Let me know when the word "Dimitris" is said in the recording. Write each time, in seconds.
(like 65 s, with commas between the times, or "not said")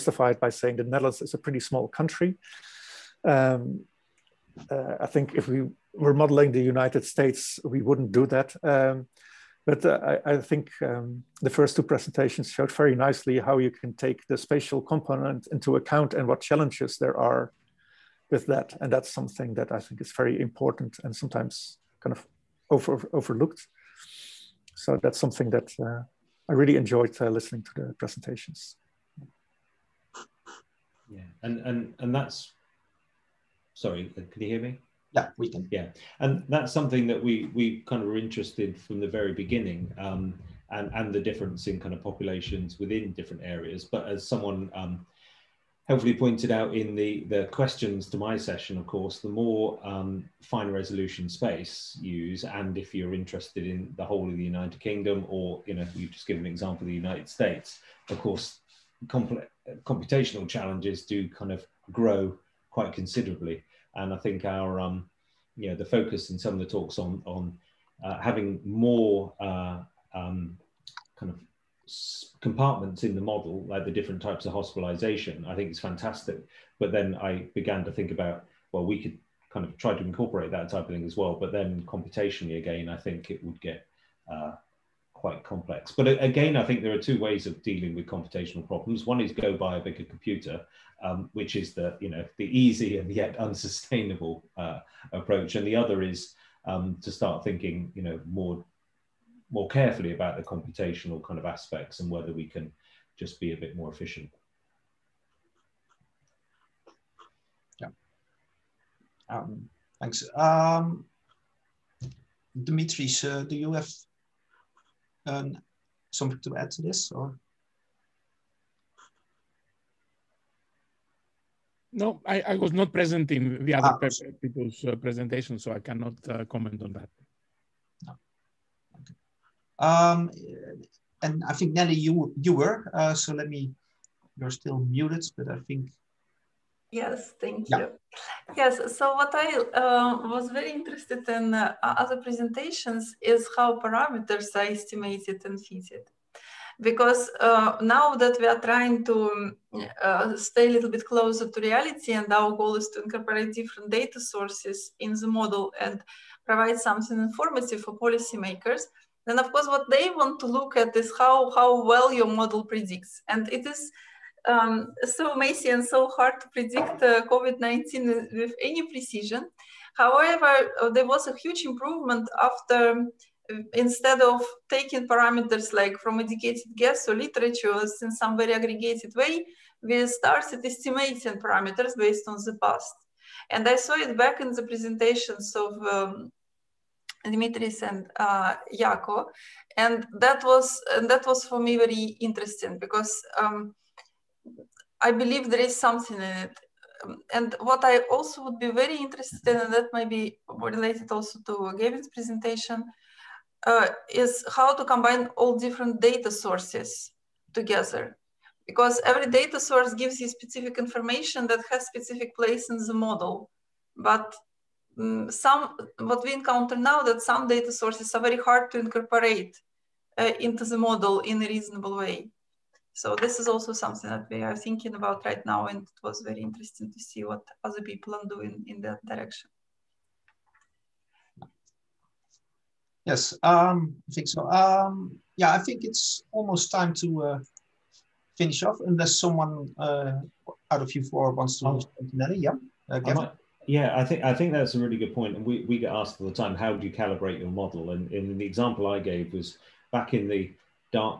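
112 s, 187 s.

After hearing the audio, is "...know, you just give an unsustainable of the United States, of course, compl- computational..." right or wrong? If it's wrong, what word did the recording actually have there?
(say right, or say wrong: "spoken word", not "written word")
wrong: "example", not "unsustainable".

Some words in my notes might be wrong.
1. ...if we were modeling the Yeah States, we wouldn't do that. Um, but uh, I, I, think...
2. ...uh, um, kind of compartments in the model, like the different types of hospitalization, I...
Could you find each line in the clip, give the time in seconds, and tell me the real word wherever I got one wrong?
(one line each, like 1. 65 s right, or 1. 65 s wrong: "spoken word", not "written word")
1. 5 s wrong: "United", not "Yeah"
2. 69 s right.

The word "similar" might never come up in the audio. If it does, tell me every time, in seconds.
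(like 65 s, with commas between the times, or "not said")
not said.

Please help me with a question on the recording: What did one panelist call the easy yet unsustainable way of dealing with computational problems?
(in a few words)
buy a bigger computer.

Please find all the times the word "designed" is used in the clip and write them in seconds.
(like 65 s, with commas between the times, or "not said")
not said.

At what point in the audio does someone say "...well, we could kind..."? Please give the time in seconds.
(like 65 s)
78 s.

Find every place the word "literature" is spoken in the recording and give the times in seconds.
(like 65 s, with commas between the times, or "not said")
177 s.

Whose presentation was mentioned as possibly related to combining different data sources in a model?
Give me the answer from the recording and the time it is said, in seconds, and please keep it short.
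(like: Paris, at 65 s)
Gavin, at 201 s.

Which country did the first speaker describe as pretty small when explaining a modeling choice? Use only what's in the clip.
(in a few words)
the Netherlands.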